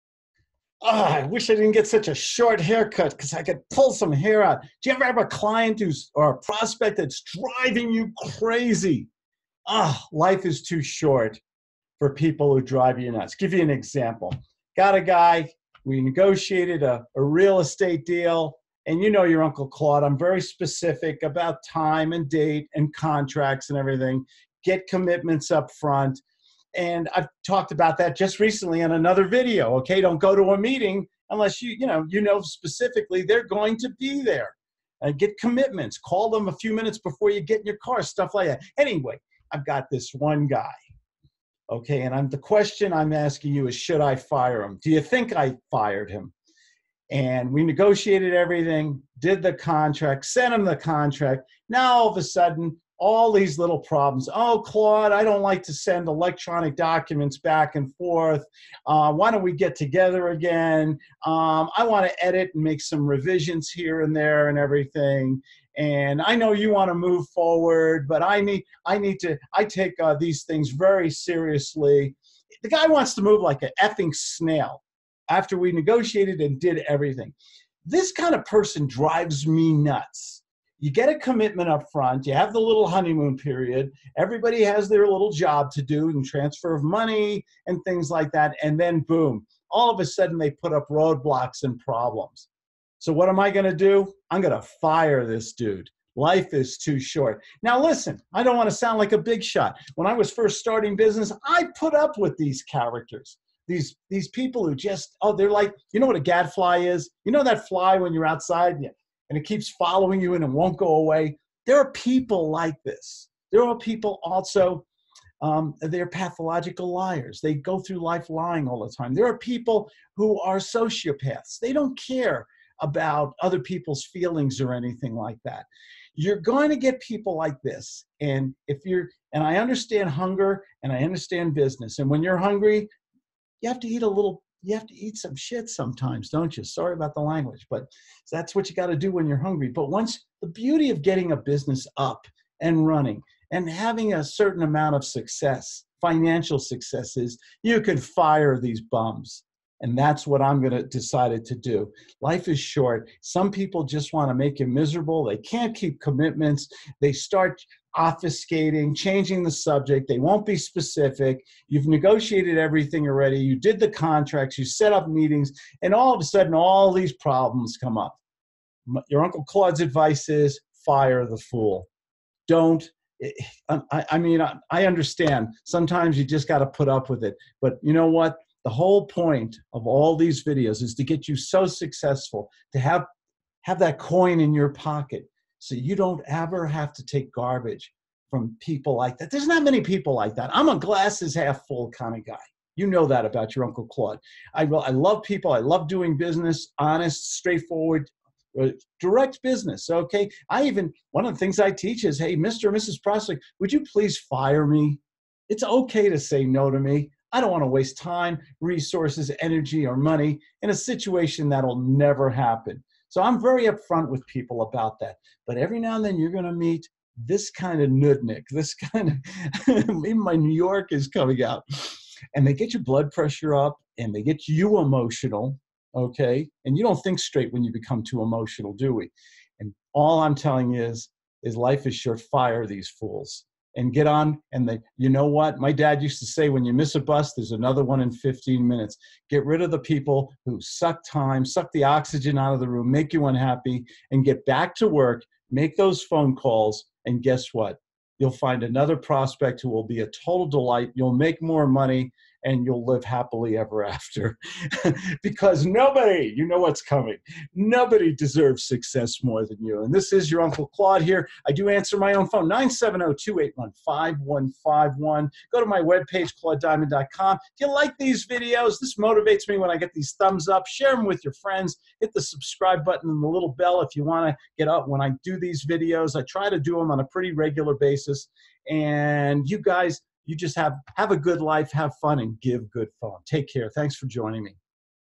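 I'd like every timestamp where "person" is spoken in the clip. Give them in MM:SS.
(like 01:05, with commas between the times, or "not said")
01:18.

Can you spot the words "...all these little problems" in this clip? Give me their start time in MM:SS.
00:53.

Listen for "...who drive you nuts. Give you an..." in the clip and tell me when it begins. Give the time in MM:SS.
00:12.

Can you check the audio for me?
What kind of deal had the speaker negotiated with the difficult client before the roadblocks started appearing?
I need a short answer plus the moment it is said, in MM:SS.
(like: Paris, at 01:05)
Real estate deal, at 00:17.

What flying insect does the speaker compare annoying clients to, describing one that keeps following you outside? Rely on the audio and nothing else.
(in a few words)
Gadfly.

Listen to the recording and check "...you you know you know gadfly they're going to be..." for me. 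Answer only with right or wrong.
wrong.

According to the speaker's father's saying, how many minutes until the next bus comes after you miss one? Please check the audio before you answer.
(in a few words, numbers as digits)
15.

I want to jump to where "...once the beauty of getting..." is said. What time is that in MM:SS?
02:19.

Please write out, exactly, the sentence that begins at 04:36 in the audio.
I try to do them on a pretty regular basis.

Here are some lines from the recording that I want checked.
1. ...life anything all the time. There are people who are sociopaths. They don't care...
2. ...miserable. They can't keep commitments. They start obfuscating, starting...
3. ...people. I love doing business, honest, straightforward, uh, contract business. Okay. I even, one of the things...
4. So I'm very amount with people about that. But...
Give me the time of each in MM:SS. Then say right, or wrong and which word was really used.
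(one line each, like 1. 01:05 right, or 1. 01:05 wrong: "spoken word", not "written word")
1. 01:58 wrong: "lying", not "anything"
2. 02:34 wrong: "changing", not "starting"
3. 03:15 wrong: "direct", not "contract"
4. 03:33 wrong: "upfront", not "amount".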